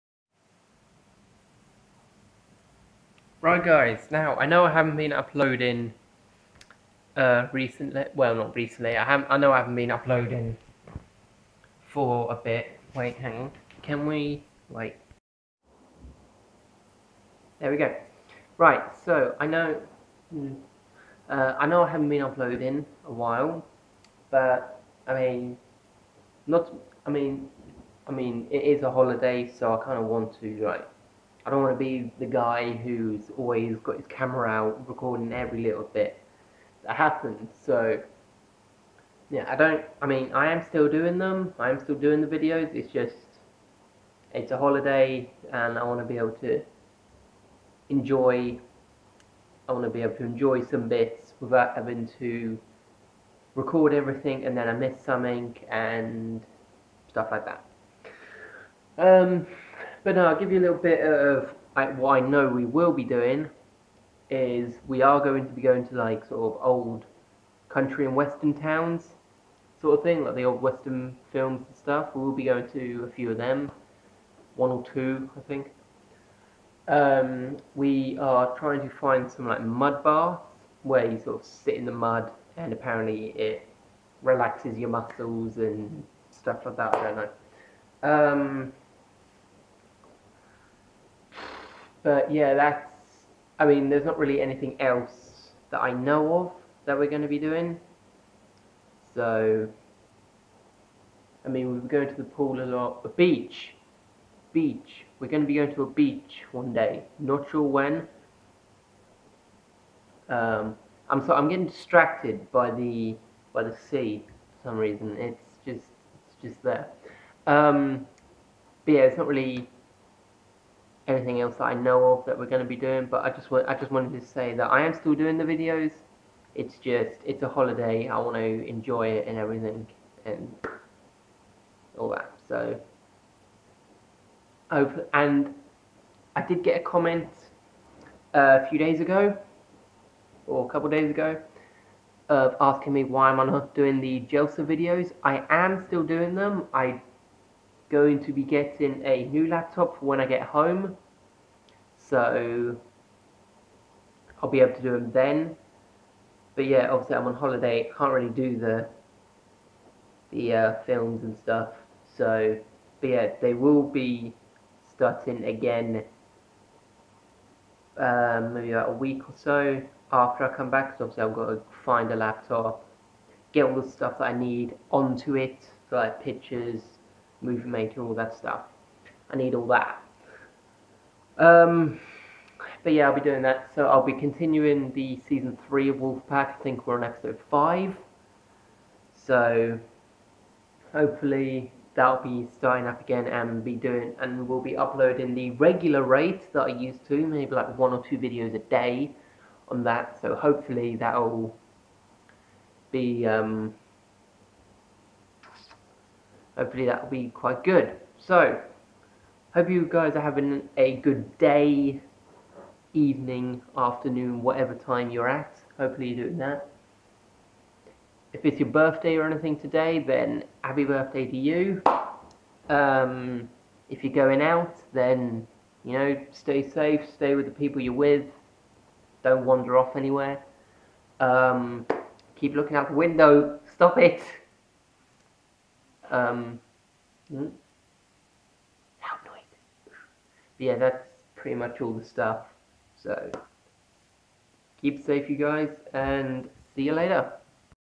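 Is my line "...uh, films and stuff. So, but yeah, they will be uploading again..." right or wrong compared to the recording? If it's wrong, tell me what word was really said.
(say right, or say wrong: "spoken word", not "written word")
wrong: "starting", not "uploading".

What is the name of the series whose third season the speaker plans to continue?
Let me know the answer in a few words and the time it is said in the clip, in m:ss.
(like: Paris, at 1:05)
Wolfpack, at 3:05.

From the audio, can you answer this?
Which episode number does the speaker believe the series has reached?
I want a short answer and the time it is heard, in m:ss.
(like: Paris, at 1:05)
5, at 3:07.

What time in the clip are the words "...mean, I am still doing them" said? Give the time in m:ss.
0:40.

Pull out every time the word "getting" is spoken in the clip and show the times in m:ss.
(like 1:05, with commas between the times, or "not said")
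1:51, 2:28.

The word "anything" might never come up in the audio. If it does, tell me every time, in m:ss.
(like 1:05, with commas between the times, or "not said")
1:34, 2:01, 3:39.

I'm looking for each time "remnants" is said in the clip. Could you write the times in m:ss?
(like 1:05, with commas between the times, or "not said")
not said.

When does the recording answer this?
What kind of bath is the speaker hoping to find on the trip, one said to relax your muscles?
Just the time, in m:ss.
1:19.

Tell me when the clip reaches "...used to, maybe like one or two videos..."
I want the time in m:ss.
3:16.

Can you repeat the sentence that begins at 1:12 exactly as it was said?
We'll be going to a few of them, one or two, I think.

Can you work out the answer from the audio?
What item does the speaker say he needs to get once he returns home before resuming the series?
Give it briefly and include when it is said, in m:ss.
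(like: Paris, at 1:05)
A new laptop, at 2:29.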